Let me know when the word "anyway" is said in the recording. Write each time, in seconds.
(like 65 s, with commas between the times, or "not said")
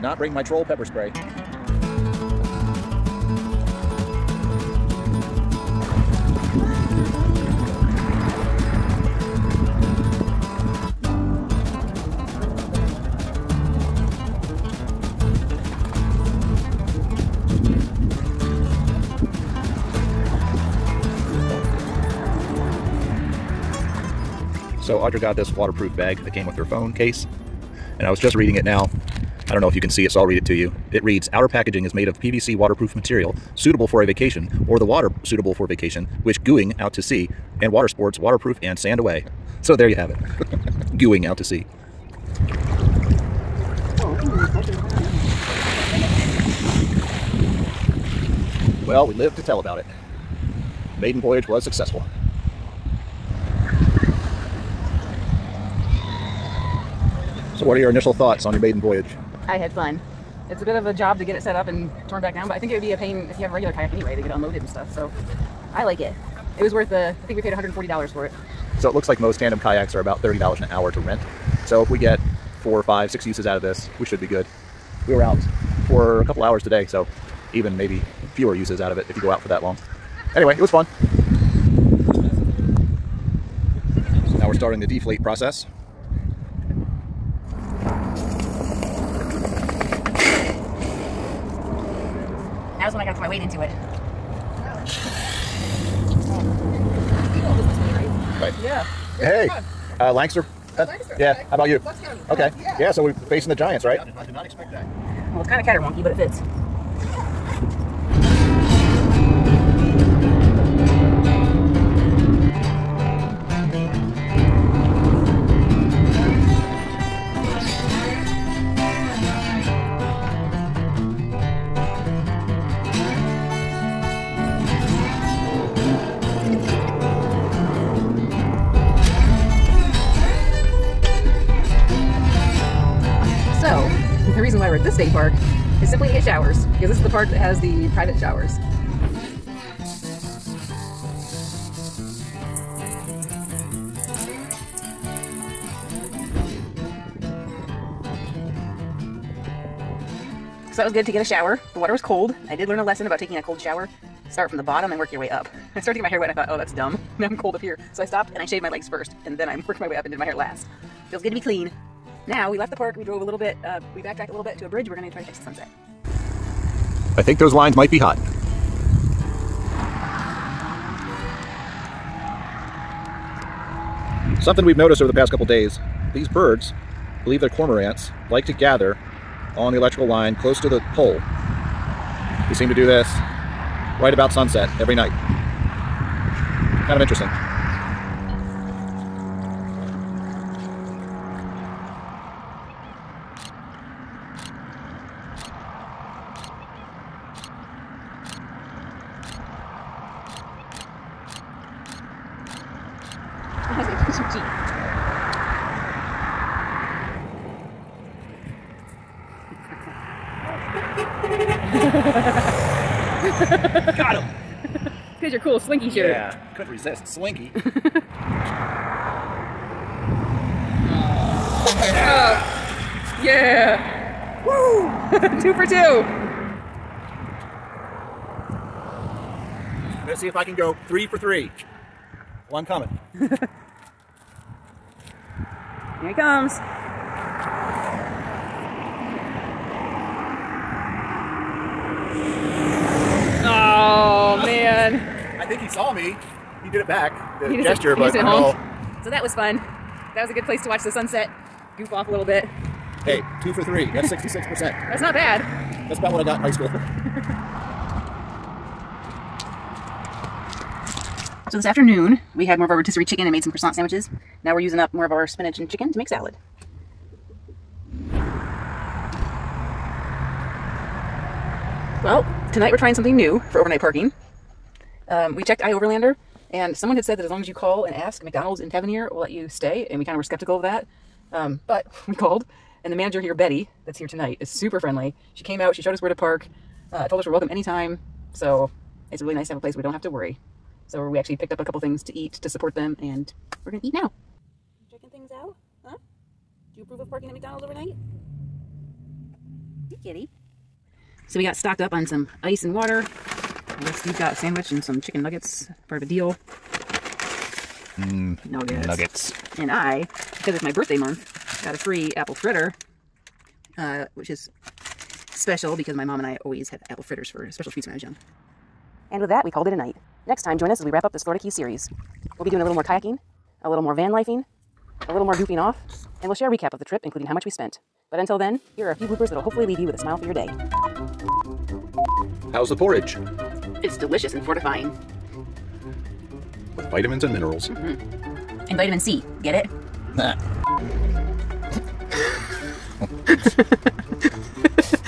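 63 s, 80 s.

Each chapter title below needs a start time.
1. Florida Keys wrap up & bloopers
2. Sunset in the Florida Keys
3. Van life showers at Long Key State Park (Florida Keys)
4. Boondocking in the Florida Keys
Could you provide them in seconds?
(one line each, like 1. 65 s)
1. 319 s
2. 126 s
3. 71 s
4. 264 s.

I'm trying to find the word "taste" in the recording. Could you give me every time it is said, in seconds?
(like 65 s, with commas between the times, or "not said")
not said.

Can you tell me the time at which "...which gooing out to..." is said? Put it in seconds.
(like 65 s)
36 s.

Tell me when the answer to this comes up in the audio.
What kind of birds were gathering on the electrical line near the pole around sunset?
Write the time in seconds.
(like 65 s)
177 s.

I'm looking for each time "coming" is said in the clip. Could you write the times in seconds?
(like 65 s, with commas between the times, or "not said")
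232 s.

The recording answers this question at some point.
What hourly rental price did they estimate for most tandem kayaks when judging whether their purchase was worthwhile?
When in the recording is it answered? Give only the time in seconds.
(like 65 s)
70 s.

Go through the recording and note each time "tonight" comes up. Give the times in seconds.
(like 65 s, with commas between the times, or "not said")
272 s, 284 s.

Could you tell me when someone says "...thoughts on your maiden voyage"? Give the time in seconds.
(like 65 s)
58 s.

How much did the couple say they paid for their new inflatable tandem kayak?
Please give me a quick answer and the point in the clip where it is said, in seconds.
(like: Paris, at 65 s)
$140, at 67 s.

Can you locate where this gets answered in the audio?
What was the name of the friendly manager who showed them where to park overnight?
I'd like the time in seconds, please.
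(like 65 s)
283 s.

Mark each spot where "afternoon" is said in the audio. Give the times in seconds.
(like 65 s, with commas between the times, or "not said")
261 s.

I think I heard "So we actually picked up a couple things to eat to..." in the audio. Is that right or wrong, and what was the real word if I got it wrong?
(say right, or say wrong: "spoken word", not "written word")
right.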